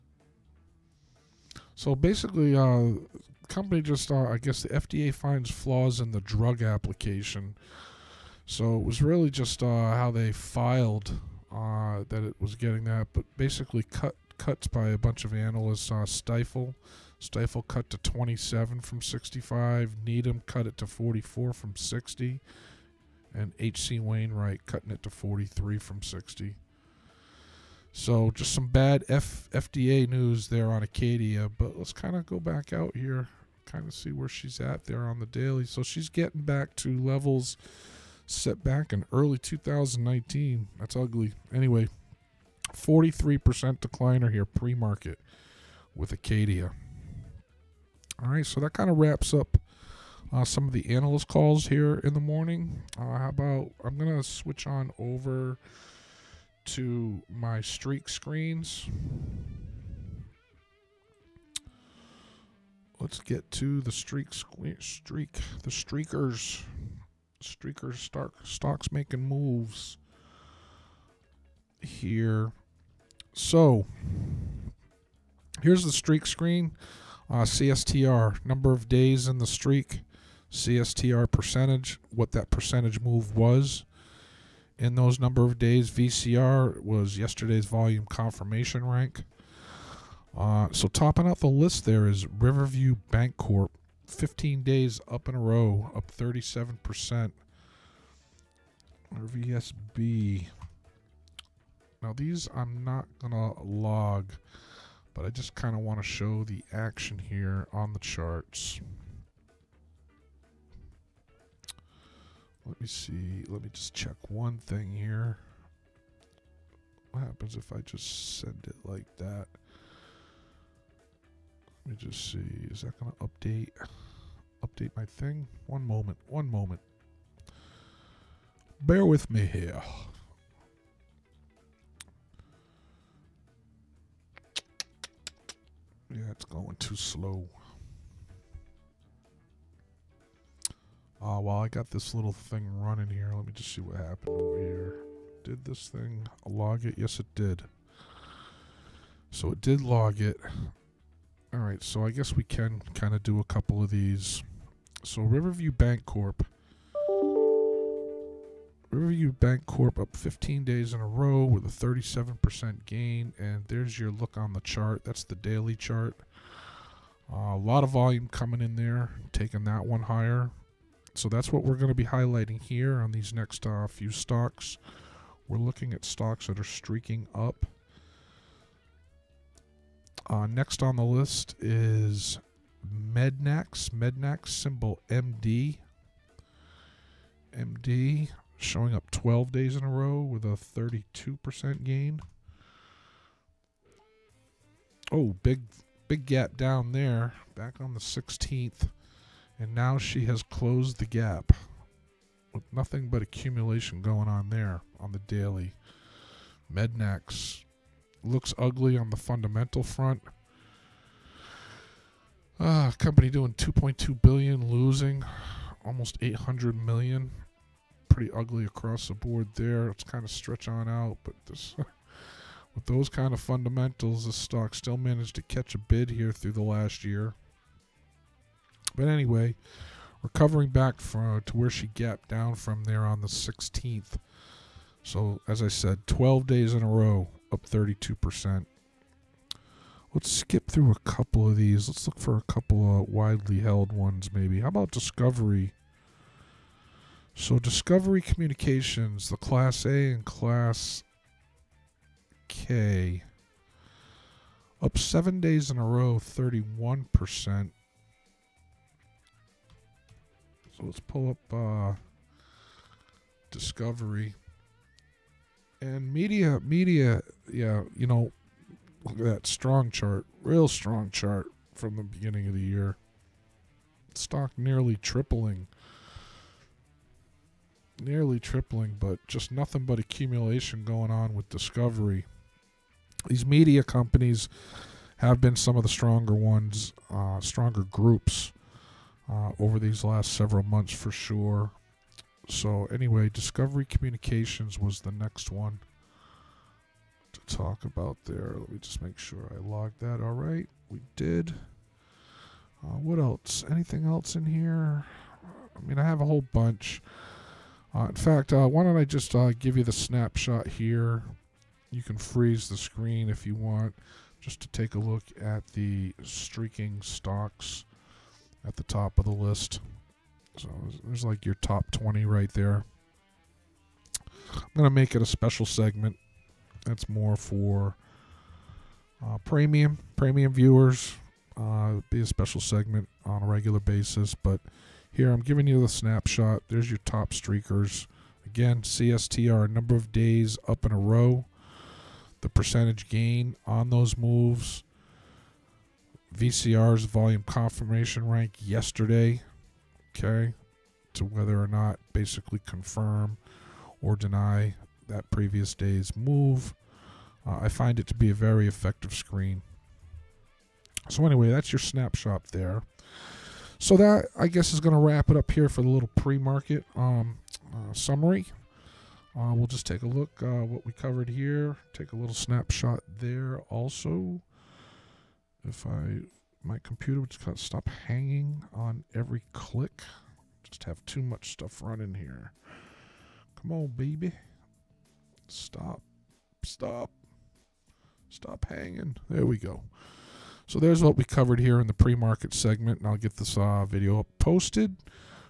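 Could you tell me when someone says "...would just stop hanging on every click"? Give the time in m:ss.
6:17.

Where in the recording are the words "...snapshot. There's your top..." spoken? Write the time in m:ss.
5:35.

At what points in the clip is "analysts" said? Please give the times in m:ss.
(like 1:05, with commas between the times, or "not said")
0:15, 0:50.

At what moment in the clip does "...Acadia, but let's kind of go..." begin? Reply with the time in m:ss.
0:30.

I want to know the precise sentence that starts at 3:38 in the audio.
Pretty ugly across the board there.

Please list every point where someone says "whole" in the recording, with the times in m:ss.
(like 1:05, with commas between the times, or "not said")
5:06.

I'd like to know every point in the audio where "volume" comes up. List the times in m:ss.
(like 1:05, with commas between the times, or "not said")
1:27, 2:47, 5:47.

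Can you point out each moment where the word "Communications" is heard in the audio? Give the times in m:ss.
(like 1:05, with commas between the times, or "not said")
4:08, 4:53.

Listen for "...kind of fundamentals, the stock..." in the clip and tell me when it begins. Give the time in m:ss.
3:43.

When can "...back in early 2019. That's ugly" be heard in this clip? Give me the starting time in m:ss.
0:38.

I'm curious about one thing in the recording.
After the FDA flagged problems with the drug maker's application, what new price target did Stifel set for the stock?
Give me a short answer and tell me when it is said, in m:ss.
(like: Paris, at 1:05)
27, at 0:17.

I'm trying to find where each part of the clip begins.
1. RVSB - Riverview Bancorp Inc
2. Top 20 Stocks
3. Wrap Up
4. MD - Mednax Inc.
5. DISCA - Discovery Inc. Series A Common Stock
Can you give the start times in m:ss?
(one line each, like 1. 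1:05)
1. 2:04
2. 5:04
3. 6:14
4. 3:10
5. 4:24.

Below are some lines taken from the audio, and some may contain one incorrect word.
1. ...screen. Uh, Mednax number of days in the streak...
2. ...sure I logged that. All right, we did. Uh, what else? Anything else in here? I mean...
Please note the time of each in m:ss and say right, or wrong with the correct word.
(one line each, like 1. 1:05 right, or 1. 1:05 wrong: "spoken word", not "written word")
1. 1:16 wrong: "CSTR", not "Mednax"
2. 4:59 right.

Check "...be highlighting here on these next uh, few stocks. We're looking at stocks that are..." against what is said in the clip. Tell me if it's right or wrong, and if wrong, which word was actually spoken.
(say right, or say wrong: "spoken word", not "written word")
right.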